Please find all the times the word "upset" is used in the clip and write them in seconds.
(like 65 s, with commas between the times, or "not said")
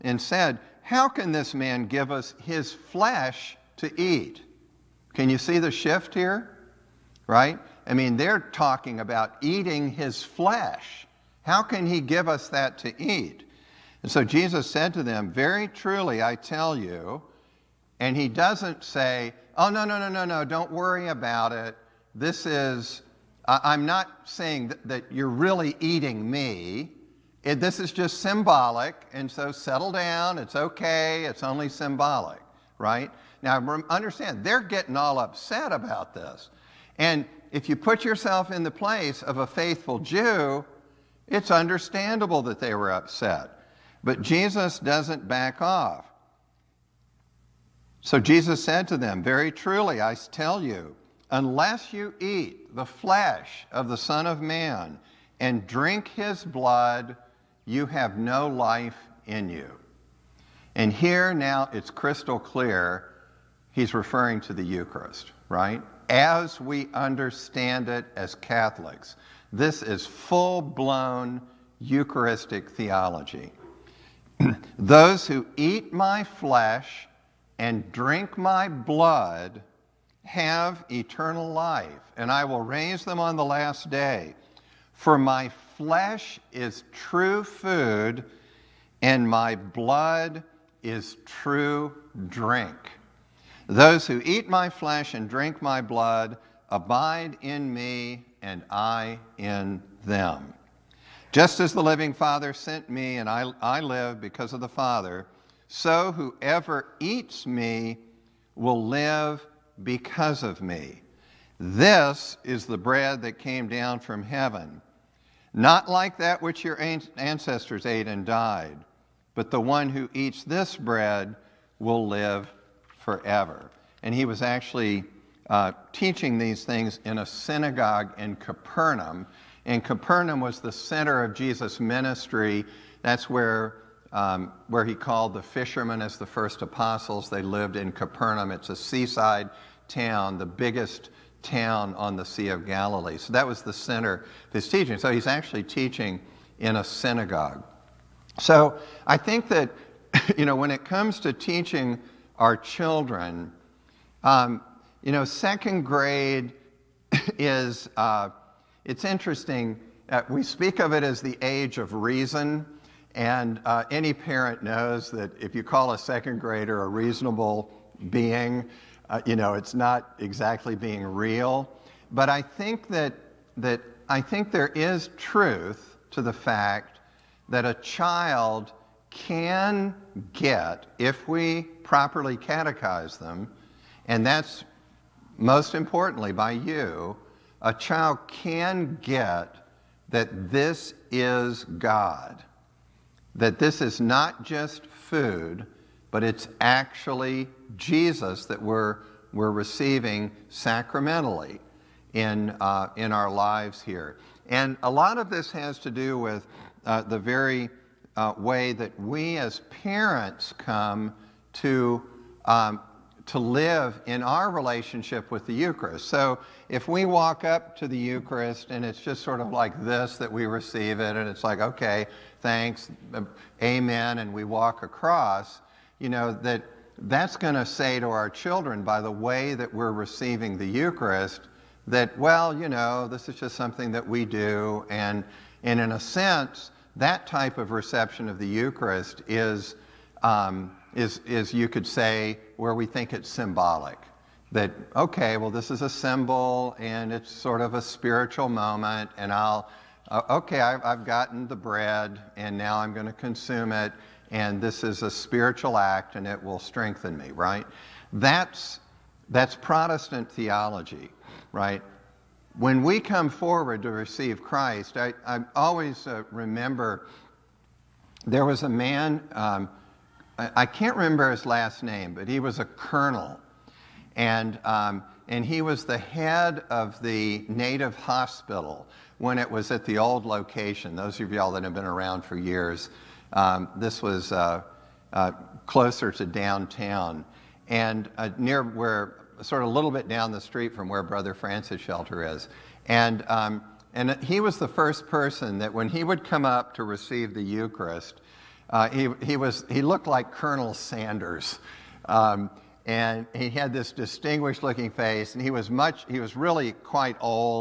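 35 s, 42 s.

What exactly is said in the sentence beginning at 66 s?
As we understand it as Catholics, this is full blown Eucharistic theology.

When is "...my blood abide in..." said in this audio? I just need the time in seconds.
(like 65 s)
95 s.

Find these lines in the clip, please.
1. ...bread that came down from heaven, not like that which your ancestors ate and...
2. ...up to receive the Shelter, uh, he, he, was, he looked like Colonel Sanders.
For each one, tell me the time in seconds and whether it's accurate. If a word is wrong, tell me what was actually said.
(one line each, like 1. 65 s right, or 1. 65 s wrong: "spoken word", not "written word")
1. 112 s right
2. 296 s wrong: "Eucharist", not "Shelter".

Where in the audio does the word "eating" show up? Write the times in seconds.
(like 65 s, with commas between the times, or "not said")
9 s, 25 s.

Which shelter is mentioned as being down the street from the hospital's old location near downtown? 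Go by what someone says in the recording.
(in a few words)
Brother Francis Shelter.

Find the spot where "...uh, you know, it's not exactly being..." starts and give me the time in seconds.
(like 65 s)
169 s.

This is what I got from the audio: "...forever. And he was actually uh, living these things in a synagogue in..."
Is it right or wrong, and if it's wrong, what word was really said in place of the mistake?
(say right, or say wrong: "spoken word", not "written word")
wrong: "teaching", not "living".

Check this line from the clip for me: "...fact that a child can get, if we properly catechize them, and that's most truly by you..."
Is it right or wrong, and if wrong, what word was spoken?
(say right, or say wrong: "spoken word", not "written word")
wrong: "importantly", not "truly".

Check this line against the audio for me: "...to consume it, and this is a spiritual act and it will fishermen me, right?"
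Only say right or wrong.
wrong.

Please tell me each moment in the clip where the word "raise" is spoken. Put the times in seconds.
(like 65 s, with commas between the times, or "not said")
82 s.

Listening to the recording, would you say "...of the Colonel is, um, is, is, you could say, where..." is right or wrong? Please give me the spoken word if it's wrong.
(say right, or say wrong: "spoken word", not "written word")
wrong: "Eucharist", not "Colonel".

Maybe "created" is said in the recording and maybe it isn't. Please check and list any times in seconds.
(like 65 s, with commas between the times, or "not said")
not said.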